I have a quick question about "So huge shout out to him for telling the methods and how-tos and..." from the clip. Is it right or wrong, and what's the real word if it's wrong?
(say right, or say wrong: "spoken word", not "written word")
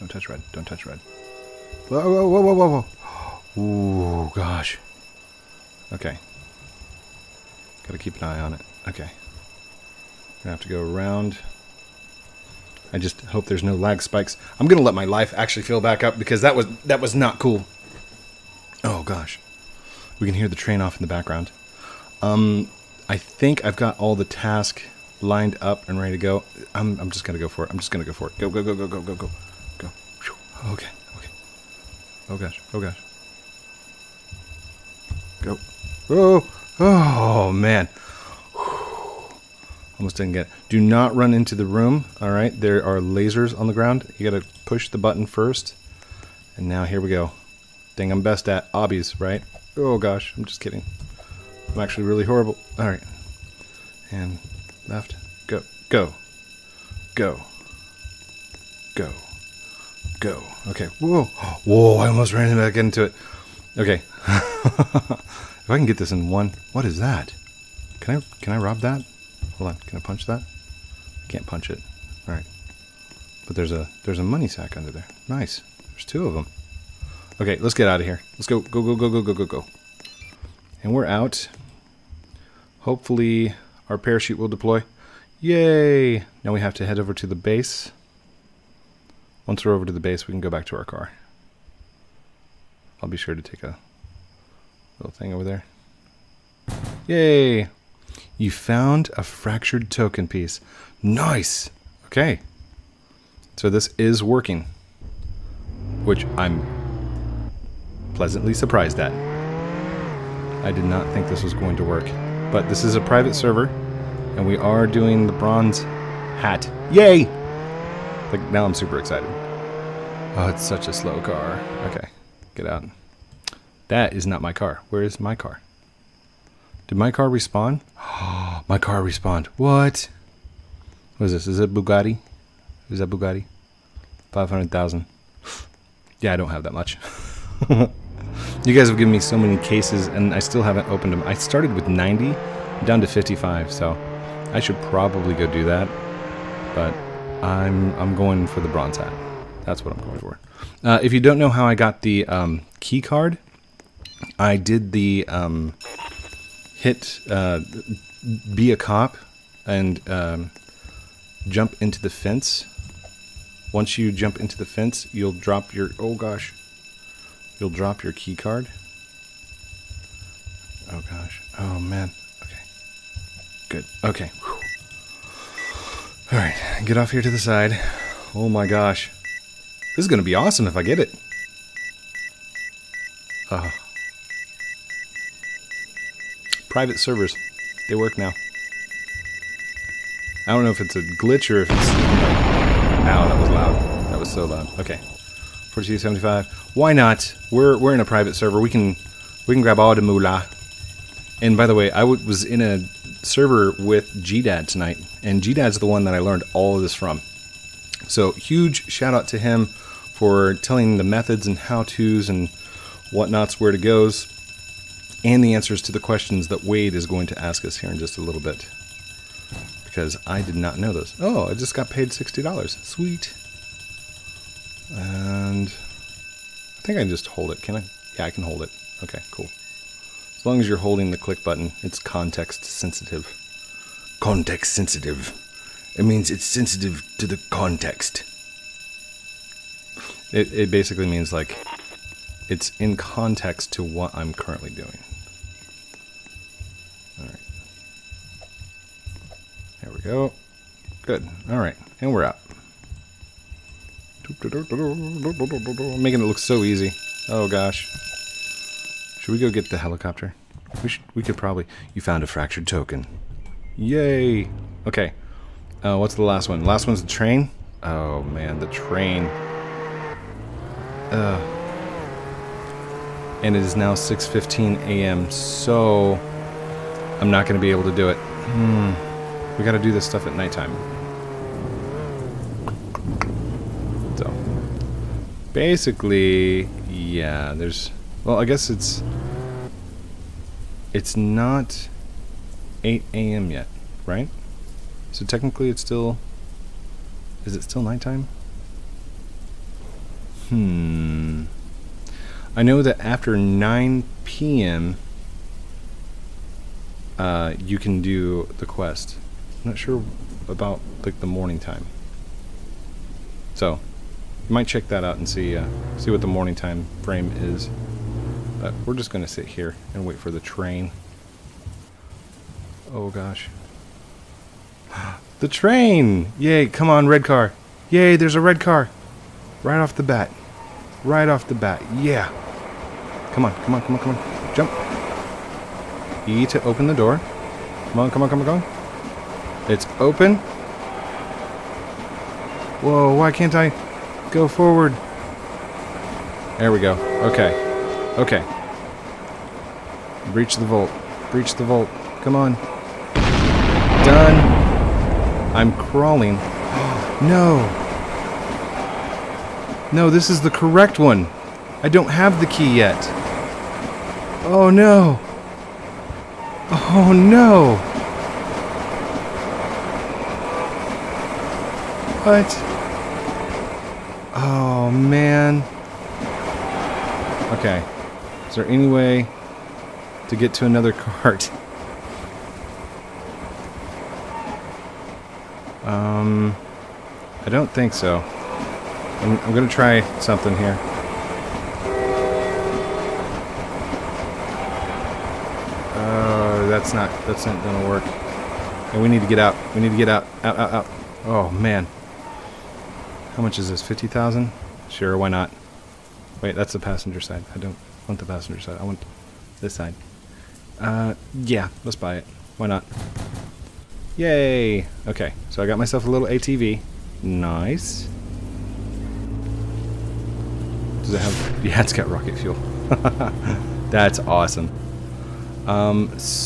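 right.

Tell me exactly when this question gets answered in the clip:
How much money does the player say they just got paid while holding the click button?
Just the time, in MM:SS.
03:42.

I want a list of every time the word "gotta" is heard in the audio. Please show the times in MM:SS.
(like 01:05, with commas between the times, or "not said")
00:07, 04:39.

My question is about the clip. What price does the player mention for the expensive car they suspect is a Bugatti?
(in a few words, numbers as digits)
500,000.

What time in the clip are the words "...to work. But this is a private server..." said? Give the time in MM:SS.
01:51.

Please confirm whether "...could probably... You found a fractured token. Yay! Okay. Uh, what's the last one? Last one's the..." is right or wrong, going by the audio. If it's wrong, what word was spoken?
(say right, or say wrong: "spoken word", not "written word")
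right.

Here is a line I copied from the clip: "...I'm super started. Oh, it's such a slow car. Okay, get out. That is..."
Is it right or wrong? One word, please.
wrong.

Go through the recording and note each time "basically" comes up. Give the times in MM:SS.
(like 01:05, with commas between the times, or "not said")
04:00, 04:45.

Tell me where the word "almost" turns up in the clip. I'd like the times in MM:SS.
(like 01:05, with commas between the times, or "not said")
00:39, 01:02.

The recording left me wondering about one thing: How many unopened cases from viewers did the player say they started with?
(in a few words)
90.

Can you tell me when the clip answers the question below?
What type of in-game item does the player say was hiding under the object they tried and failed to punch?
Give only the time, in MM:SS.
01:14.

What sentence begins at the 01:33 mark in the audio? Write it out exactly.
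I'll be sure to take a Little thing over there.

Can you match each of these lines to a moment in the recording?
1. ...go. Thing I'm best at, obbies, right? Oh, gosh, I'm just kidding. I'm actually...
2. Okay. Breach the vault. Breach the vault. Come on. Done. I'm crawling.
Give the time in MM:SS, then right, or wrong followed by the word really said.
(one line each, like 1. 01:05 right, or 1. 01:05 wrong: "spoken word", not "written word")
1. 00:47 right
2. 05:48 right.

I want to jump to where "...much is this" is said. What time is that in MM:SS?
06:43.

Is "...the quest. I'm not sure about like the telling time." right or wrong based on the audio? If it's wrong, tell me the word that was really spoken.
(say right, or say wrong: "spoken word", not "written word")
wrong: "morning", not "telling".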